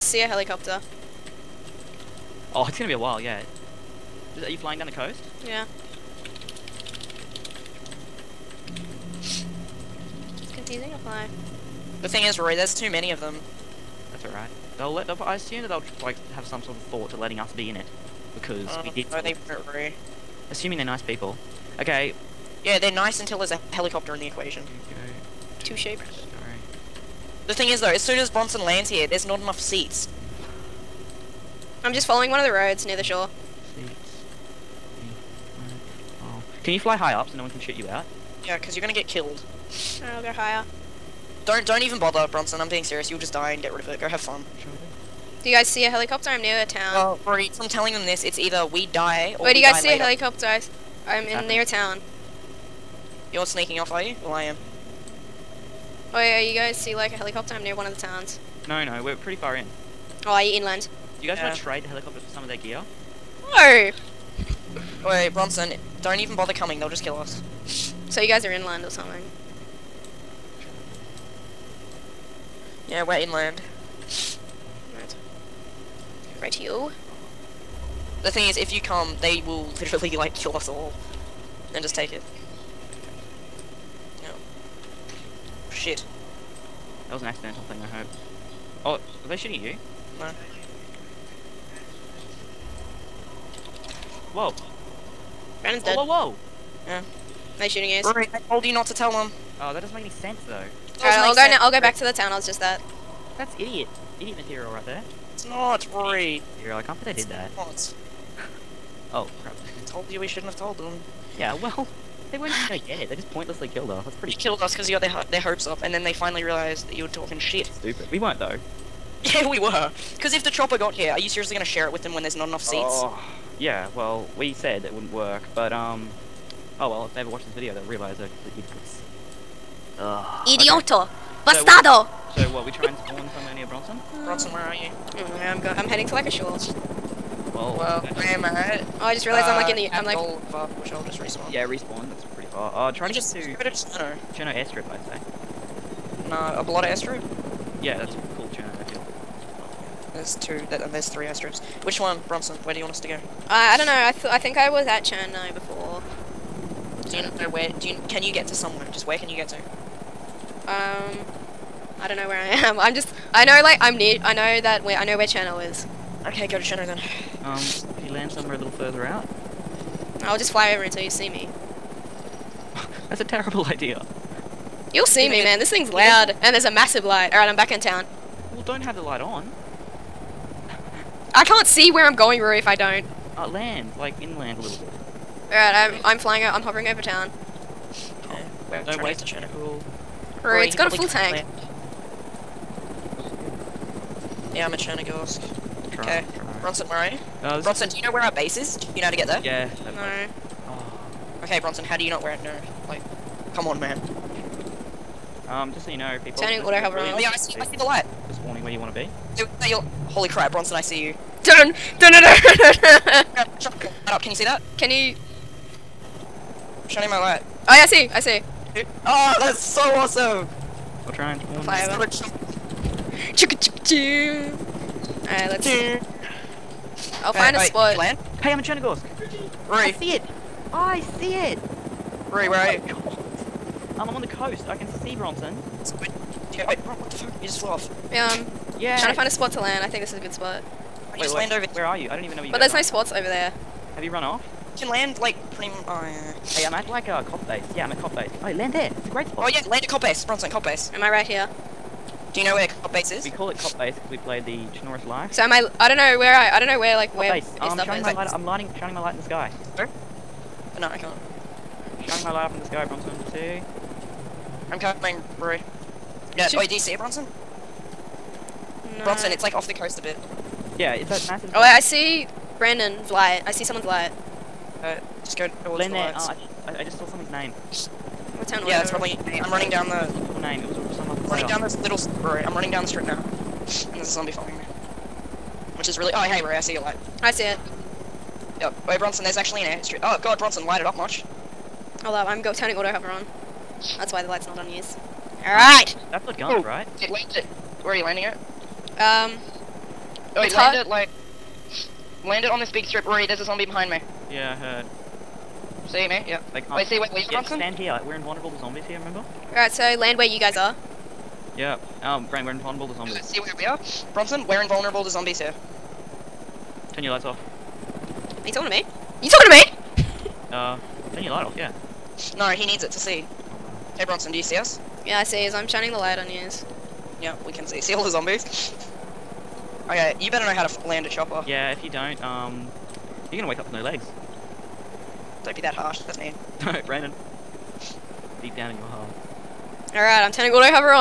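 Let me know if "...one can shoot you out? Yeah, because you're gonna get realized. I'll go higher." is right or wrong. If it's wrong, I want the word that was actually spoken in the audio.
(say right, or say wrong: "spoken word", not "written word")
wrong: "killed", not "realized".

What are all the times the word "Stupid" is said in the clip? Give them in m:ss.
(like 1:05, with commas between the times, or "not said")
1:57.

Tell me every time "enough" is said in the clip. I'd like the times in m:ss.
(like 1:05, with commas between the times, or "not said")
0:29, 2:02.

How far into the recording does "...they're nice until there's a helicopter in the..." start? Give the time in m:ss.
0:22.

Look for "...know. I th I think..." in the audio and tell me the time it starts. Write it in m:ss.
2:33.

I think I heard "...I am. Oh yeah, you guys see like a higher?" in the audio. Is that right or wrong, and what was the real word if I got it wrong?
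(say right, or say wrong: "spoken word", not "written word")
wrong: "helicopter", not "higher".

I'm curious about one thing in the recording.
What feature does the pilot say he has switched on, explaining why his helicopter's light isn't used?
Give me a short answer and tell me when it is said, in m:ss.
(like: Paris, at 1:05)
Auto hover, at 4:52.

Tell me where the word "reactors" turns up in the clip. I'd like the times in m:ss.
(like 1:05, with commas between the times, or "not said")
not said.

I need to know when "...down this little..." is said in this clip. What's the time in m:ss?
4:41.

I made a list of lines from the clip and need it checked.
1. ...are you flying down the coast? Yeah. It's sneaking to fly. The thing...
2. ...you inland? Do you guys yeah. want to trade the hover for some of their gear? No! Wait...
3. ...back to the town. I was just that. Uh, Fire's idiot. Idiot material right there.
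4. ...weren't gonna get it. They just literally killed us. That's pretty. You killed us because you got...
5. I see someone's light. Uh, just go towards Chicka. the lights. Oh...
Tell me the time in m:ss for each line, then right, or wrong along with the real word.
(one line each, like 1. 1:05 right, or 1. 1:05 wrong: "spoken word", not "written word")
1. 0:04 wrong: "confusing", not "sneaking"
2. 1:00 wrong: "helicopter", not "hover"
3. 1:41 wrong: "That", not "Fire"
4. 1:52 wrong: "pointlessly", not "literally"
5. 4:33 wrong: "Lynette", not "Chicka".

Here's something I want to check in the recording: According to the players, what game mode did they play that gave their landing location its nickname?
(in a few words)
Chernarus life.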